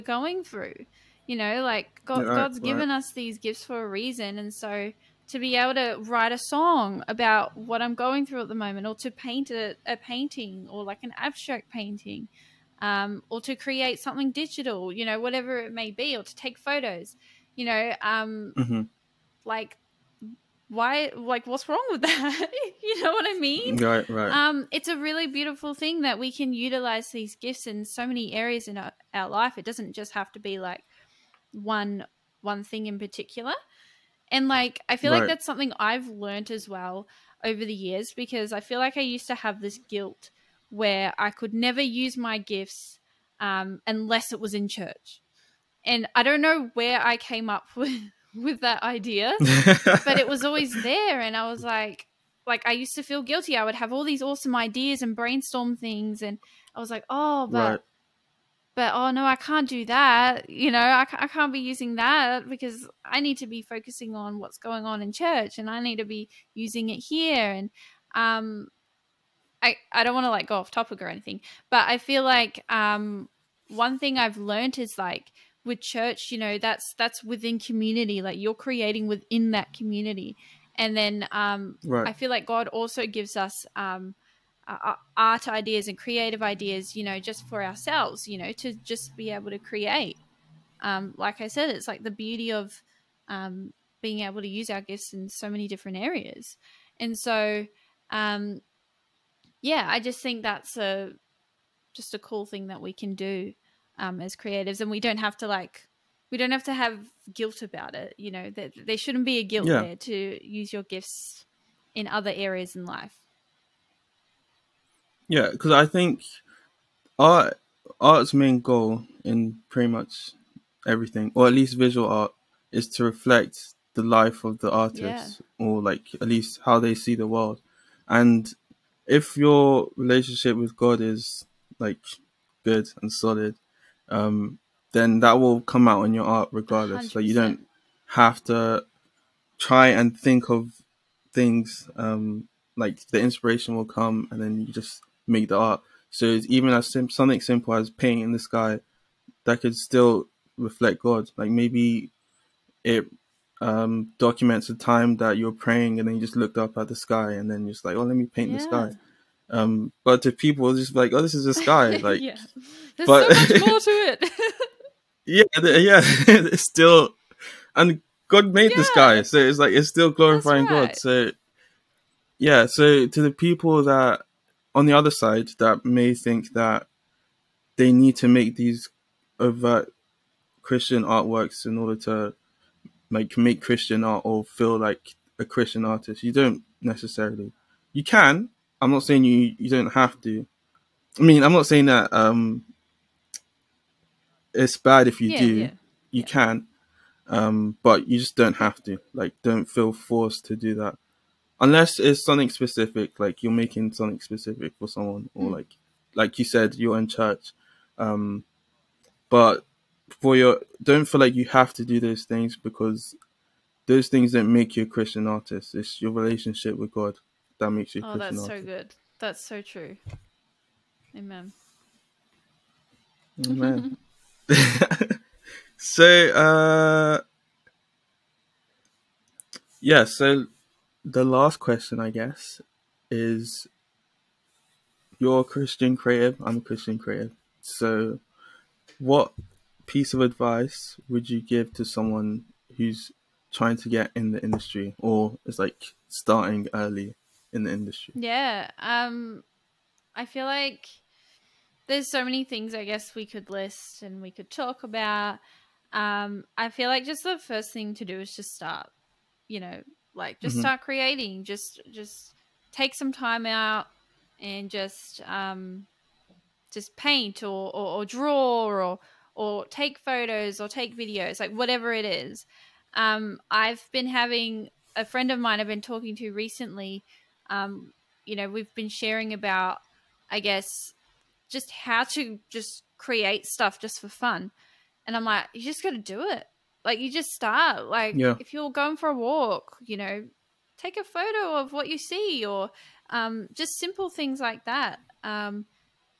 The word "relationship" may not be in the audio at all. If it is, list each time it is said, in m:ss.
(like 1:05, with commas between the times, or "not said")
2:09, 3:36.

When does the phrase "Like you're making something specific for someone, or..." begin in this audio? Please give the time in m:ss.
3:23.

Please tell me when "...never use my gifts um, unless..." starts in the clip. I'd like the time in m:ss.
0:41.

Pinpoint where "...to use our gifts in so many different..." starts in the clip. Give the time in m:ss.
1:34.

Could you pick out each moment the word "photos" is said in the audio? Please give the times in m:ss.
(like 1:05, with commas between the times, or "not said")
0:16, 4:29, 4:51.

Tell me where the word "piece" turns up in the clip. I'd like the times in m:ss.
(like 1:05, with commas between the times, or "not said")
3:59.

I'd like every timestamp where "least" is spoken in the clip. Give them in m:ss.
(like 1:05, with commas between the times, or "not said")
2:01, 2:06.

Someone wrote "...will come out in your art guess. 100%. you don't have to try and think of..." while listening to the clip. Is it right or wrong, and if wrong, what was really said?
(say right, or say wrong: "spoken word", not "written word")
wrong: "regardless", not "guess".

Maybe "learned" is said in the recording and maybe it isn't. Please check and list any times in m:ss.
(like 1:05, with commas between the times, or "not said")
0:36, 1:14.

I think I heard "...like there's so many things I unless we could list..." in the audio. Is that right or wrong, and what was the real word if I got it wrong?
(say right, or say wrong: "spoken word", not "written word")
wrong: "guess", not "unless".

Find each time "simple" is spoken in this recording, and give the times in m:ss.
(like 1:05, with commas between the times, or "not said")
2:27, 4:53.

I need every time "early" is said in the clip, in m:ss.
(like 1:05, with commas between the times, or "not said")
4:06.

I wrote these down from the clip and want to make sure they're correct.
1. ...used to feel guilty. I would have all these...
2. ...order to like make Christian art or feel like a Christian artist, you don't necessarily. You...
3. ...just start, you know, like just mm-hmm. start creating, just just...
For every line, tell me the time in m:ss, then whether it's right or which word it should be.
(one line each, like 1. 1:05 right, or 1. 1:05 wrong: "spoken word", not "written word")
1. 0:52 right
2. 3:01 right
3. 4:18 right.